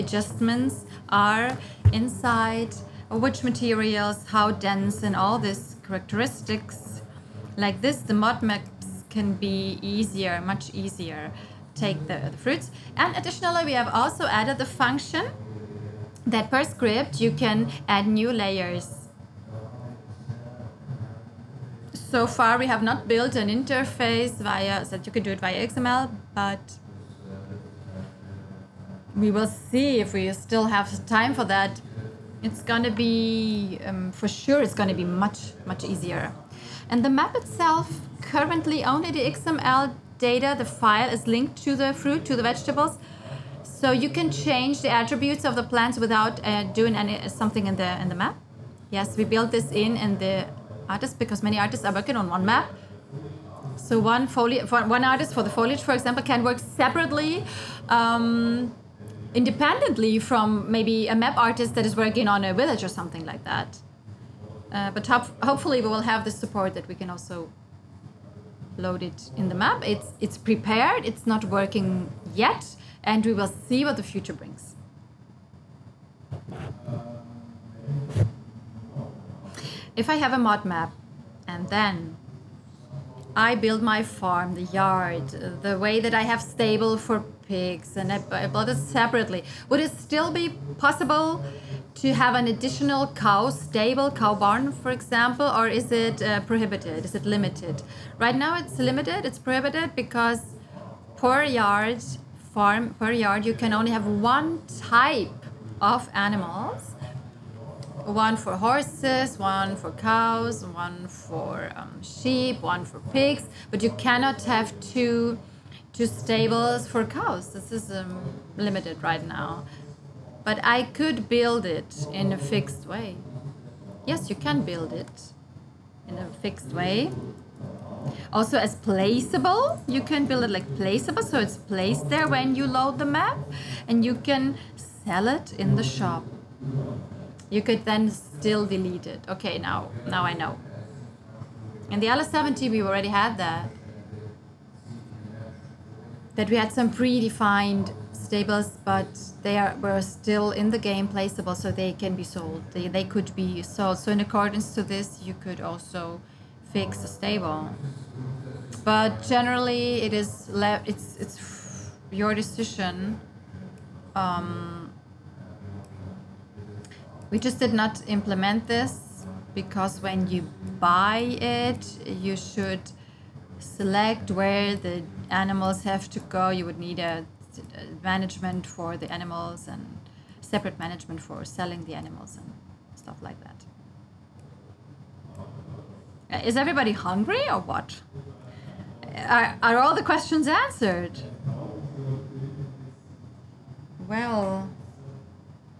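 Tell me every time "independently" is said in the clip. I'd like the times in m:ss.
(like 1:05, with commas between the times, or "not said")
0:59.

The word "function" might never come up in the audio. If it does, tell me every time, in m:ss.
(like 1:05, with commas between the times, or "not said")
0:14.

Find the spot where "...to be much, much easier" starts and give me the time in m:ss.
0:34.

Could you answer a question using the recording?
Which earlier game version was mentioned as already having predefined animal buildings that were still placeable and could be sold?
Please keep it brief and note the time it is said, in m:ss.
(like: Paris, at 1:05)
LS17, at 2:22.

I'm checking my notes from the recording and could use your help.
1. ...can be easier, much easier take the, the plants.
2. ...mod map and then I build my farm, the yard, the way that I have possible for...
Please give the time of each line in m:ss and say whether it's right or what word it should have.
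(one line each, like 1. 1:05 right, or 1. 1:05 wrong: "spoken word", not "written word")
1. 0:09 wrong: "fruits", not "plants"
2. 1:20 wrong: "stable", not "possible".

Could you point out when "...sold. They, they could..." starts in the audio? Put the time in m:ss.
2:32.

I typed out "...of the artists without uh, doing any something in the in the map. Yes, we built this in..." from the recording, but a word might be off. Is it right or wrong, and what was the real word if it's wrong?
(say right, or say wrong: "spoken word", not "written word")
wrong: "plants", not "artists".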